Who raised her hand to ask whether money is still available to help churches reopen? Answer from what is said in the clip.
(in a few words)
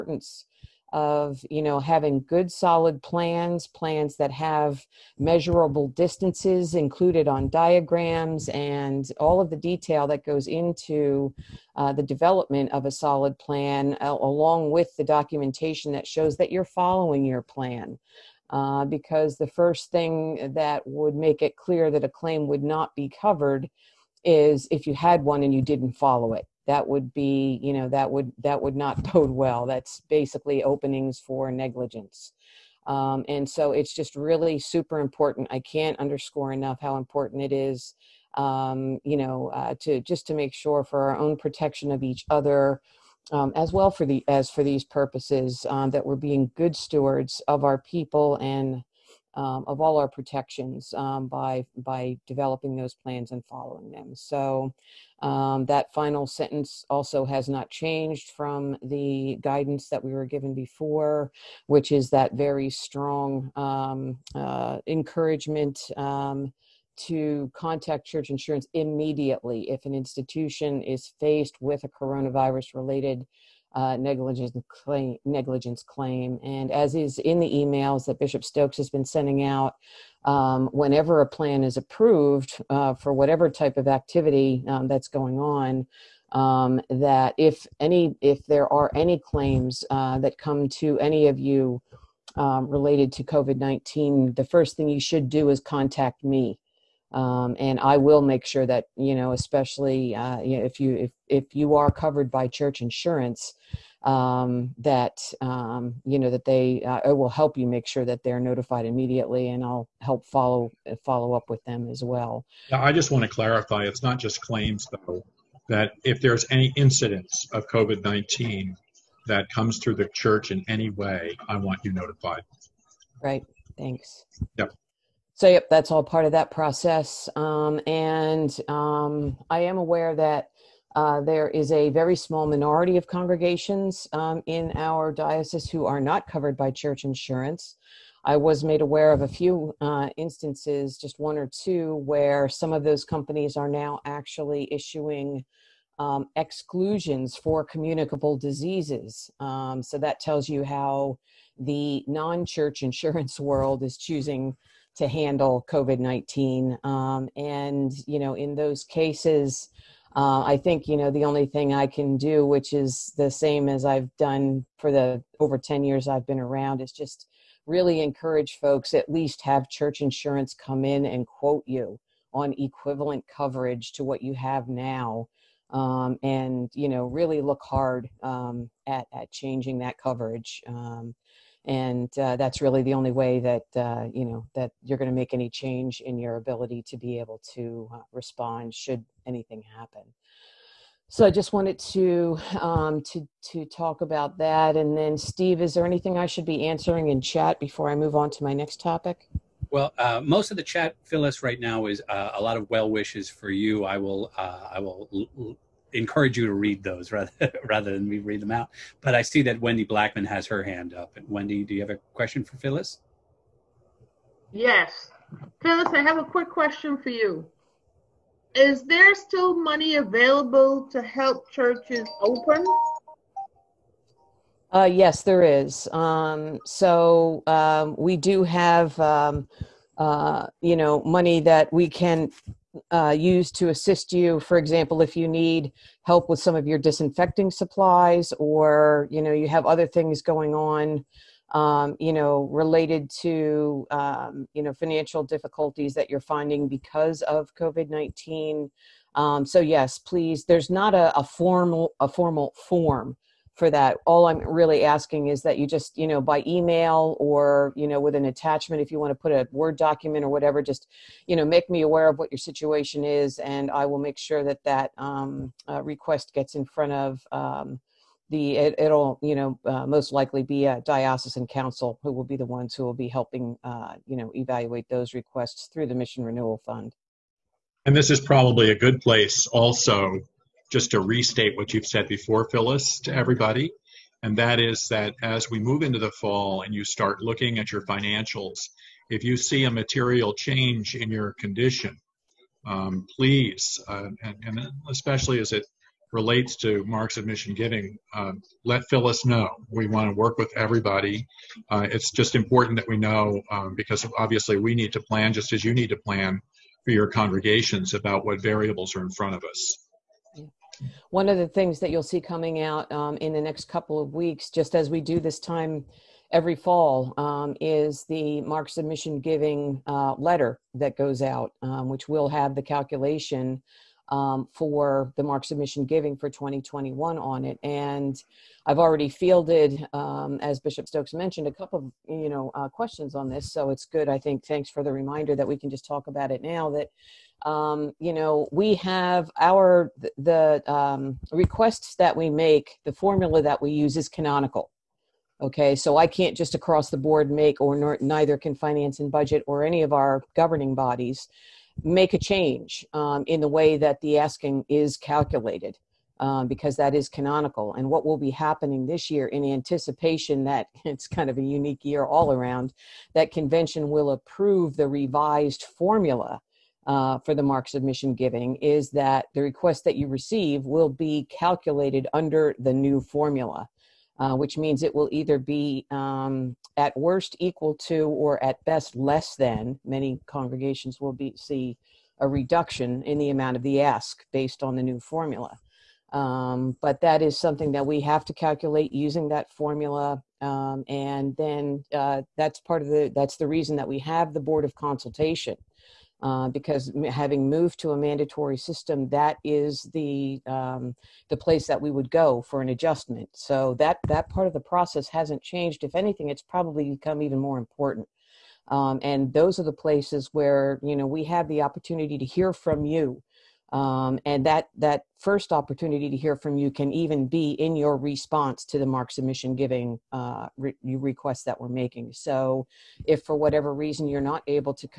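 Wendy Blackman.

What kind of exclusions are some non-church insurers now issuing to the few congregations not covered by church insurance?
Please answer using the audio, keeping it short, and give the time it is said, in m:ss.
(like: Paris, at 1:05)
communicable diseases, at 2:26.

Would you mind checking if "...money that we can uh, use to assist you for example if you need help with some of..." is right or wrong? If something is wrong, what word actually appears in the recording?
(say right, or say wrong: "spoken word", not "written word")
right.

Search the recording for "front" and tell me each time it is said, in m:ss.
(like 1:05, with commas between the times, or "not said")
4:26, 5:09.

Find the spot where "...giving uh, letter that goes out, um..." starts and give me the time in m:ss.
5:19.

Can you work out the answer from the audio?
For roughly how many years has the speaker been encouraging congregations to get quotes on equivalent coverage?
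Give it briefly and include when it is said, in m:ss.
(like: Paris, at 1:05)
over 10 years, at 2:45.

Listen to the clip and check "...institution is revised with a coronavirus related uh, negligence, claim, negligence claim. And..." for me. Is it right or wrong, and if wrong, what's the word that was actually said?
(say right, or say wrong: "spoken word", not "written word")
wrong: "faced", not "revised".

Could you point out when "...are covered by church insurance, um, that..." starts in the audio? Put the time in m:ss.
1:41.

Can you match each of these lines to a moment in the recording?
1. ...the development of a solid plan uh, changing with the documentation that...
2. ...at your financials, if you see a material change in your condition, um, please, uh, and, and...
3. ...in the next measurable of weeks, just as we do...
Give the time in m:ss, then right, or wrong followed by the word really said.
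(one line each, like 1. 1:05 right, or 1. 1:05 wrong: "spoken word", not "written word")
1. 0:11 wrong: "along", not "changing"
2. 4:47 right
3. 5:13 wrong: "couple", not "measurable".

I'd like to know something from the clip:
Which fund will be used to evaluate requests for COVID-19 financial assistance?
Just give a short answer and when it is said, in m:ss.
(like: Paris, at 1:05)
Mission Renewal Fund, at 4:35.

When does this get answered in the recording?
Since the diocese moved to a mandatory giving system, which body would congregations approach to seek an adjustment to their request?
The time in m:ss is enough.
6:34.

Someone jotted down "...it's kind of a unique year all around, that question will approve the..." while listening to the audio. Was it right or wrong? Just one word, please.
wrong.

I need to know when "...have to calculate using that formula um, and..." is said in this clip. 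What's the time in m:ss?
6:28.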